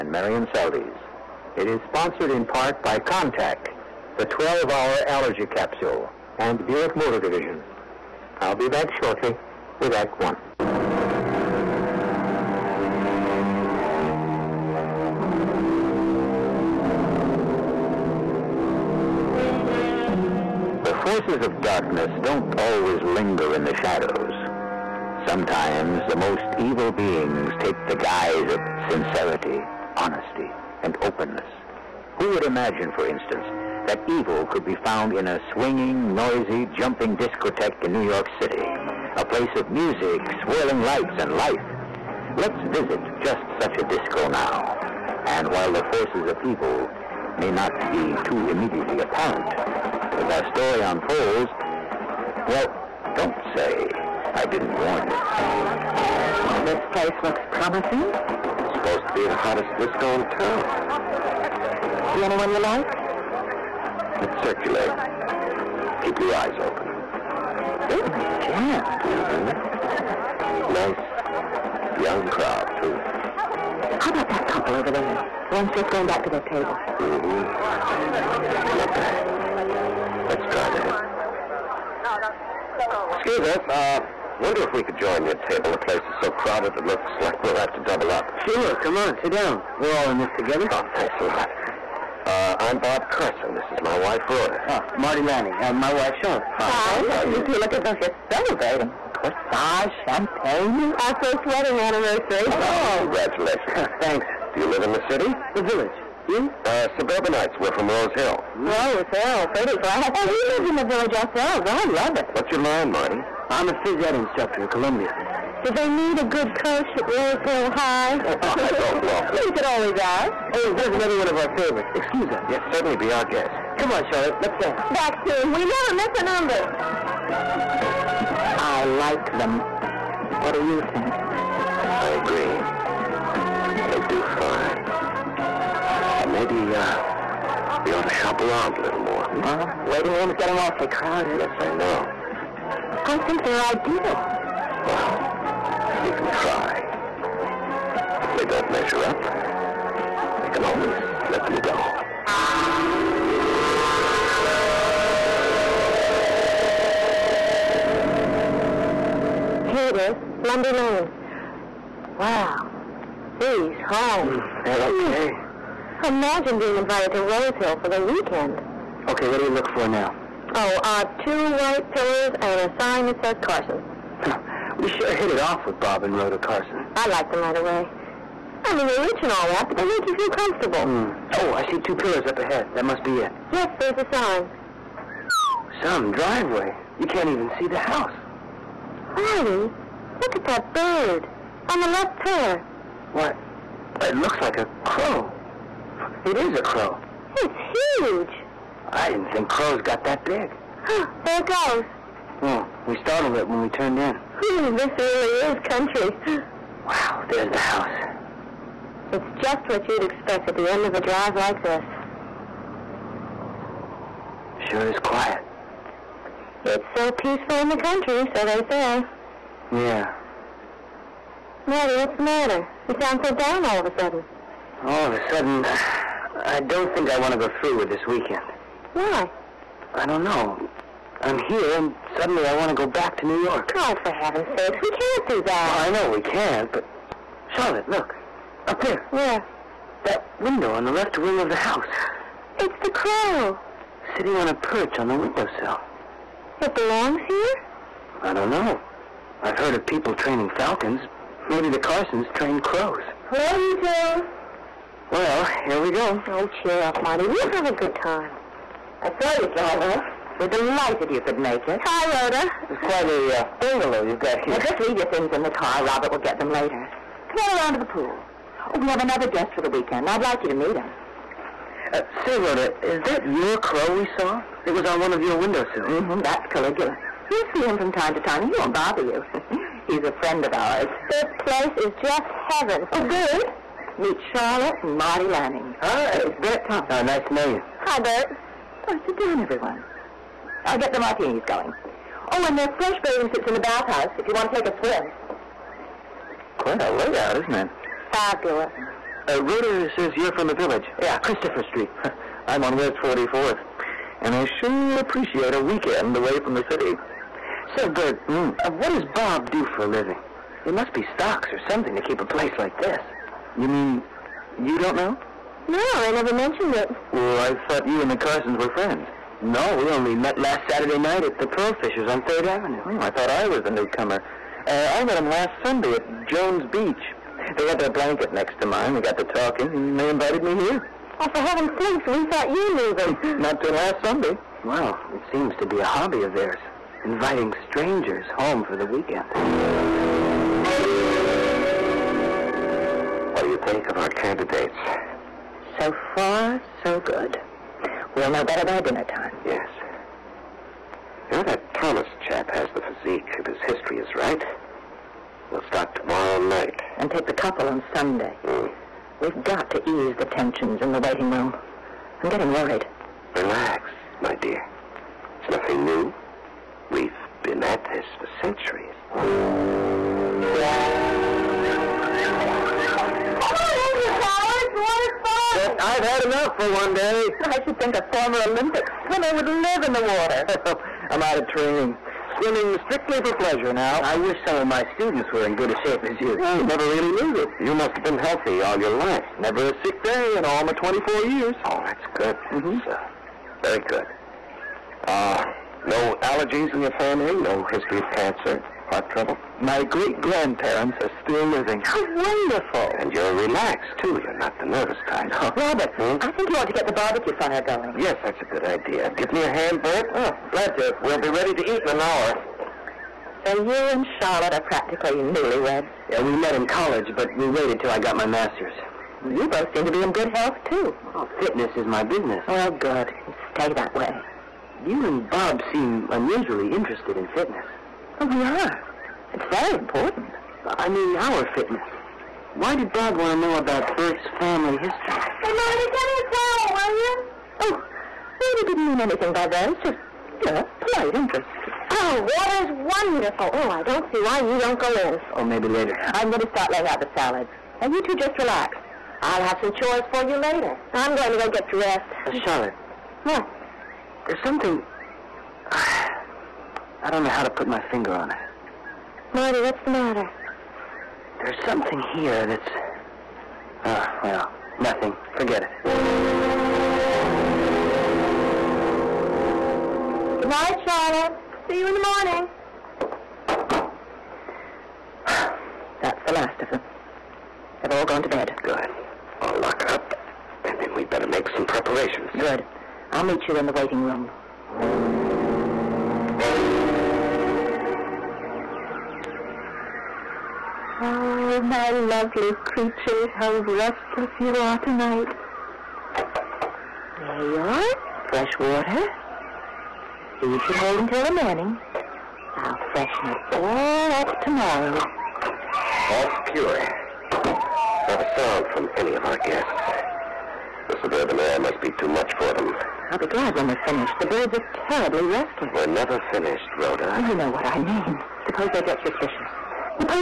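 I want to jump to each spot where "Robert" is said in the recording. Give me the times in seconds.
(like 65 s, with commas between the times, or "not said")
265 s, 405 s, 438 s.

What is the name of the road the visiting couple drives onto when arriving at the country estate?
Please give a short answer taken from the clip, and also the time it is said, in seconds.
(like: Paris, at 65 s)
Lundy Lane, at 160 s.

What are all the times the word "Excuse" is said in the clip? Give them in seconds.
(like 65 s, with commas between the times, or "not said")
83 s, 121 s.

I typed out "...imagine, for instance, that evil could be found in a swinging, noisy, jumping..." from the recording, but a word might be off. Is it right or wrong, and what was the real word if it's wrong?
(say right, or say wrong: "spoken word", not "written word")
right.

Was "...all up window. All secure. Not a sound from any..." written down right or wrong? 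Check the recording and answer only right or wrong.
wrong.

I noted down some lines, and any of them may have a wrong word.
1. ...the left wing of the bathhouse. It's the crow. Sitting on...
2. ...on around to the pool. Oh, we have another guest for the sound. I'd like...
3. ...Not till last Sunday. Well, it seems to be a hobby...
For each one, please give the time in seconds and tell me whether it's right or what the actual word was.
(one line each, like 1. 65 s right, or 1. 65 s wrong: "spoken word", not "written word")
1. 240 s wrong: "house", not "bathhouse"
2. 267 s wrong: "weekend", not "sound"
3. 333 s right.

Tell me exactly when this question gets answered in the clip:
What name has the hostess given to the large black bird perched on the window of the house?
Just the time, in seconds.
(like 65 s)
276 s.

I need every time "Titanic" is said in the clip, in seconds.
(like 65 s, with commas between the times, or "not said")
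not said.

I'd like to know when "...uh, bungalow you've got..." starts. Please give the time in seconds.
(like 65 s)
263 s.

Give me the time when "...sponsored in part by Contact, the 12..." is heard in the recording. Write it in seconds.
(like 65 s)
1 s.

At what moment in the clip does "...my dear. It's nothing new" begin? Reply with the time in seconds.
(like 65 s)
364 s.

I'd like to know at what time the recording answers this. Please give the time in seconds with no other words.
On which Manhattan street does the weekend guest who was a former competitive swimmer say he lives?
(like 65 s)
302 s.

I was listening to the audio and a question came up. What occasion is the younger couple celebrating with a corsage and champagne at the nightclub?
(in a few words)
First wedding anniversary.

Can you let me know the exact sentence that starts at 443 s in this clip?
Oh, I don't see why you don't go in.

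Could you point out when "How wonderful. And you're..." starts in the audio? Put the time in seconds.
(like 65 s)
401 s.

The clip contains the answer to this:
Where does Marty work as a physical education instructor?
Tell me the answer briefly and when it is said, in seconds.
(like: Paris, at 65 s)
Columbia, at 114 s.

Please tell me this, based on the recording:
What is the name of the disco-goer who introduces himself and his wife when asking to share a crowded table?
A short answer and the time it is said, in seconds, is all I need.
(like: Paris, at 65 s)
Bob Carson, at 92 s.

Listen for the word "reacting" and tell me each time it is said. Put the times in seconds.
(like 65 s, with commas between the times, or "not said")
not said.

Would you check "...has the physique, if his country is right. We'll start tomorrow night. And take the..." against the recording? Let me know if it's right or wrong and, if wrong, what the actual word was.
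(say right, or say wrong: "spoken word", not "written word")
wrong: "history", not "country".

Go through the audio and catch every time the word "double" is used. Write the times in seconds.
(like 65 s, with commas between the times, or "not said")
87 s.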